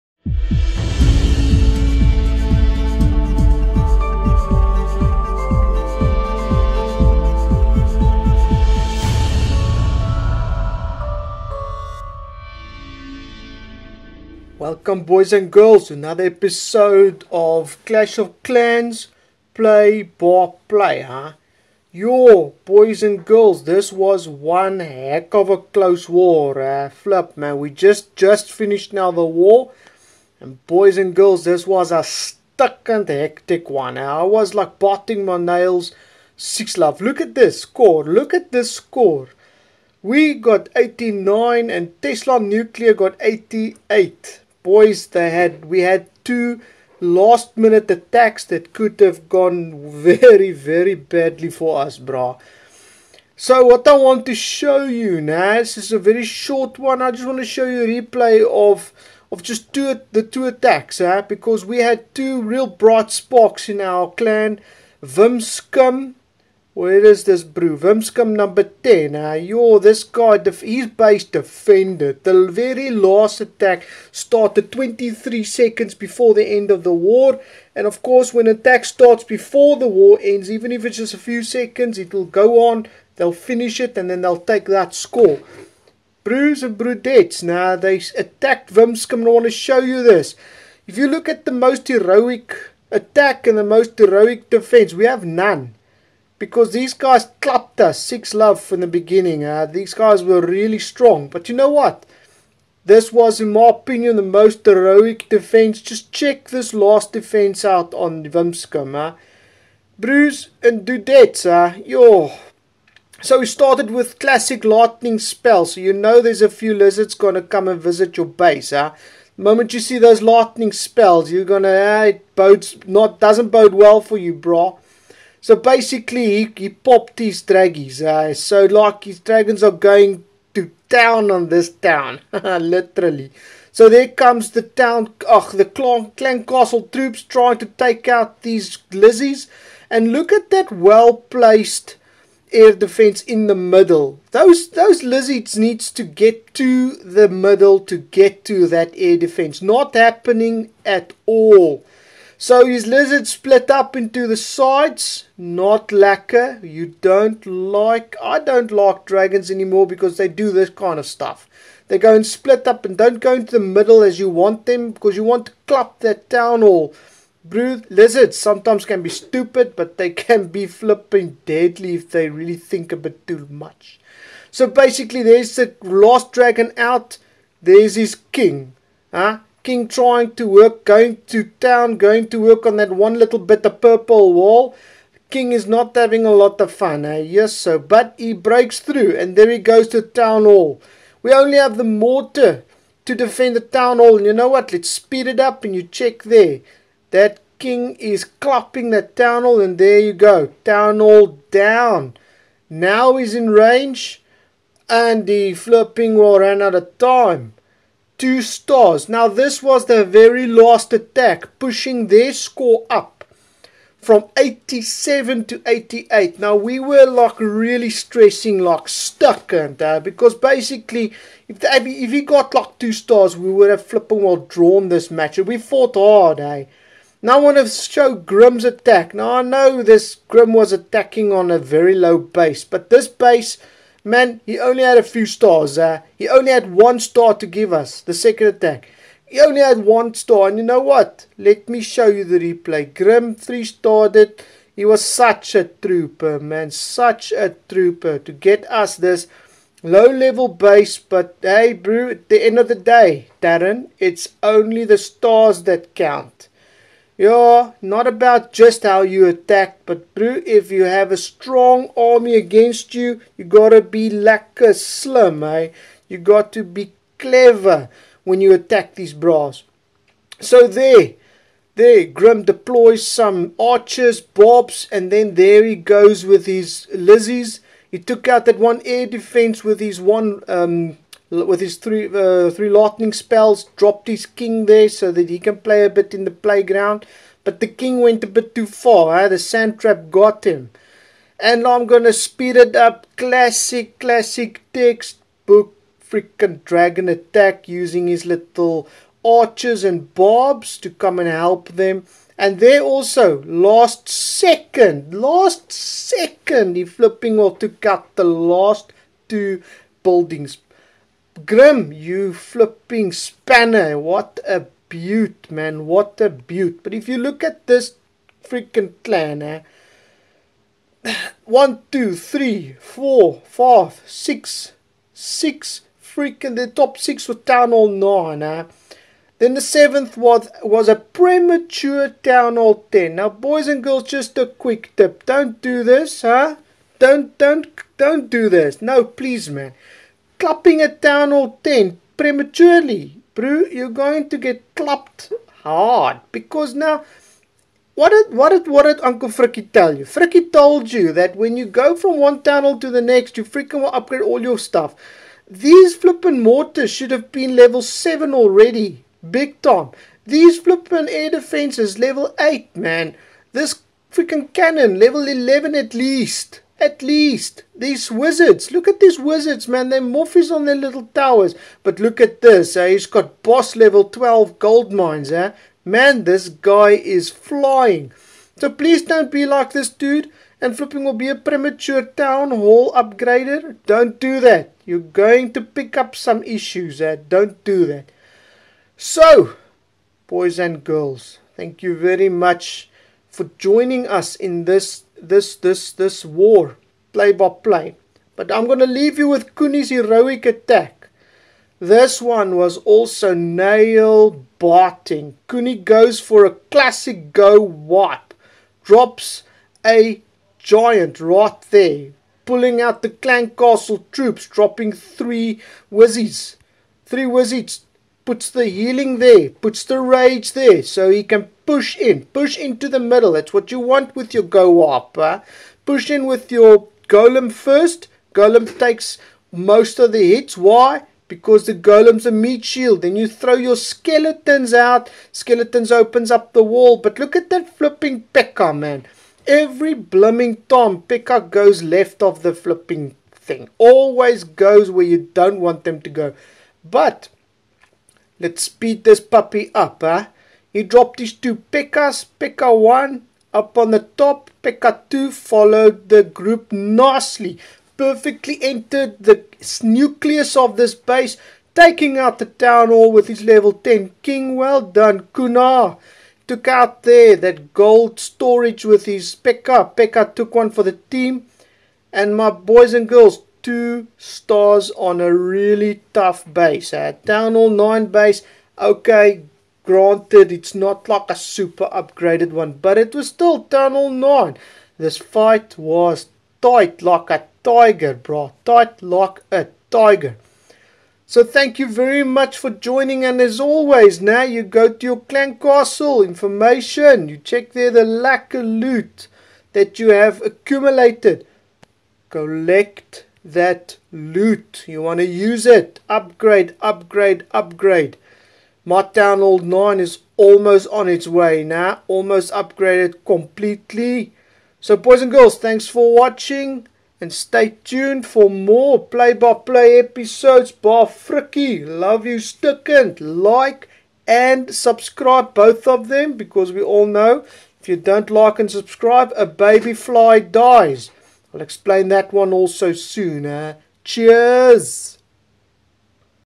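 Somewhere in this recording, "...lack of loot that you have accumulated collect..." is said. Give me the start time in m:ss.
8:18.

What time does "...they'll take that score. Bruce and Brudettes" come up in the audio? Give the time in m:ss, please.
1:24.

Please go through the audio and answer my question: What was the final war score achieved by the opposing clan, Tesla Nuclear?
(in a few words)
88.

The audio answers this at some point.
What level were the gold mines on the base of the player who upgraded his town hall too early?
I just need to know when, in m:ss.
6:13.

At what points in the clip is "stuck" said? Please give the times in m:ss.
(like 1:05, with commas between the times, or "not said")
0:32, 3:38.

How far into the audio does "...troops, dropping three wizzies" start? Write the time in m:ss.
6:54.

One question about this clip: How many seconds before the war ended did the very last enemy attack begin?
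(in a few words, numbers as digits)
23.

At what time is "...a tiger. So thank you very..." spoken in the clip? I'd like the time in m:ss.
8:09.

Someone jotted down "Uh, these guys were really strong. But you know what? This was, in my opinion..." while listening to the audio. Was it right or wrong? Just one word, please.
right.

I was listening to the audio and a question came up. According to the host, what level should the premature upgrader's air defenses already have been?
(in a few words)
Level 8.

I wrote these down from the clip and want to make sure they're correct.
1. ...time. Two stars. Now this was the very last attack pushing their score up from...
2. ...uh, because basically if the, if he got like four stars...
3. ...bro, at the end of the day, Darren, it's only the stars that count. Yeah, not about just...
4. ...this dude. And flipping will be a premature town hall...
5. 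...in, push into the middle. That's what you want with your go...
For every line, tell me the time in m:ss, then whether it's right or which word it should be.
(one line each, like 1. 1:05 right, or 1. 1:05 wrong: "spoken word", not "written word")
1. 3:26 right
2. 3:39 wrong: "two", not "four"
3. 4:11 right
4. 6:19 right
5. 7:01 right.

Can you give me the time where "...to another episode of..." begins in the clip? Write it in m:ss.
0:15.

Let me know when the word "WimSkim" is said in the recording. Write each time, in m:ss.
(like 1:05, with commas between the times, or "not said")
1:48.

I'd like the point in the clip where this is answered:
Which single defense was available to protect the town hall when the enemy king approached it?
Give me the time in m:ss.
3:11.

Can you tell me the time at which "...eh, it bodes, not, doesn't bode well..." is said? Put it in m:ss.
2:01.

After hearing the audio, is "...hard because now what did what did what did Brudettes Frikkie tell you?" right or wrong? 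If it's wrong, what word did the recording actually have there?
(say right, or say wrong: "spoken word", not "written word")
wrong: "Uncle", not "Brudettes".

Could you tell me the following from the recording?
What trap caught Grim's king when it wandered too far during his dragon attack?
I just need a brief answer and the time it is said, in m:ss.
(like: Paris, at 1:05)
Sand trap, at 4:49.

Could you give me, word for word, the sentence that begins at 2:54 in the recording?
So basically, there's the last dragon out.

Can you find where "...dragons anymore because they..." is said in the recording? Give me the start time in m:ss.
2:39.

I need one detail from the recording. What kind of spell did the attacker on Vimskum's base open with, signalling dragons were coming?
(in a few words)
Lightning spell.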